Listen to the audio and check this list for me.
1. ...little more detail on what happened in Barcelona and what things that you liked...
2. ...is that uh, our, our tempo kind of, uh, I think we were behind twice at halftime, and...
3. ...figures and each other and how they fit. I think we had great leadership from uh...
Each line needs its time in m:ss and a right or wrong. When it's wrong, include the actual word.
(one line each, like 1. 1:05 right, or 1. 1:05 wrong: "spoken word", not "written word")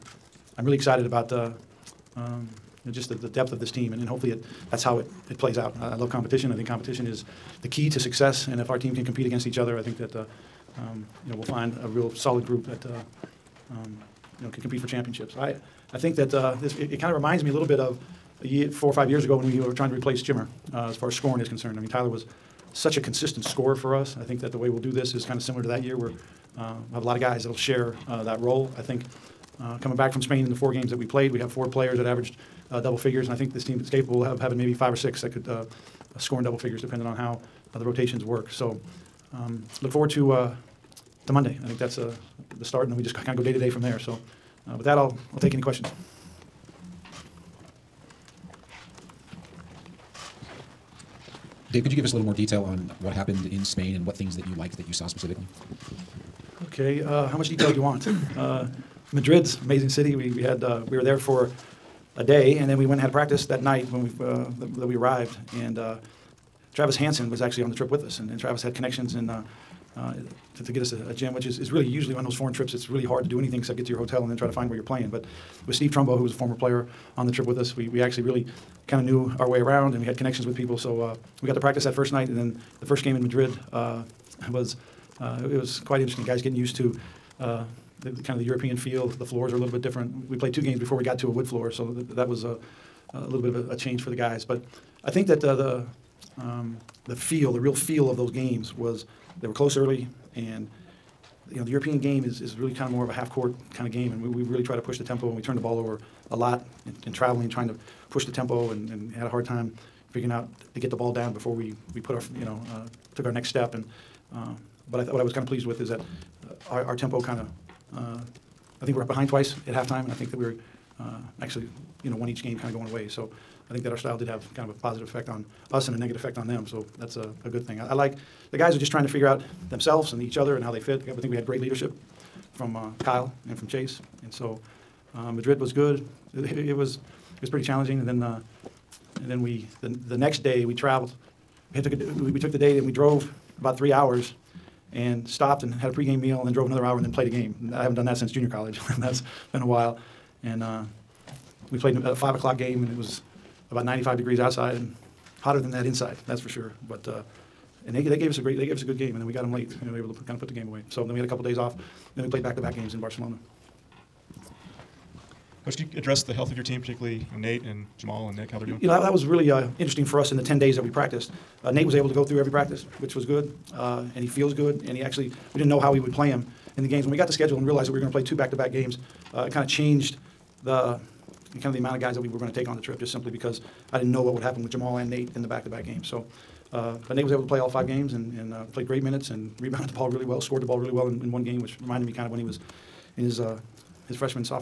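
1. 0:52 wrong: "Spain", not "Barcelona"
2. 1:55 right
3. 2:09 wrong: "themselves", not "figures".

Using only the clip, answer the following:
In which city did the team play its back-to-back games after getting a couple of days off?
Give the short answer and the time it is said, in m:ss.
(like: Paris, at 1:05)
Barcelona, at 2:42.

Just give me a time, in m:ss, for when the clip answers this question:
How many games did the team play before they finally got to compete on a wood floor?
1:30.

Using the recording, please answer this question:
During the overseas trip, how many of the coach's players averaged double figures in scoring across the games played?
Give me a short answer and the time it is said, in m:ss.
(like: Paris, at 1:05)
4, at 0:31.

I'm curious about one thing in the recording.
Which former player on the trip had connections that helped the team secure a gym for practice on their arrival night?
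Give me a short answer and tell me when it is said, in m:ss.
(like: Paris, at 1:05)
Travis Hansen, at 1:06.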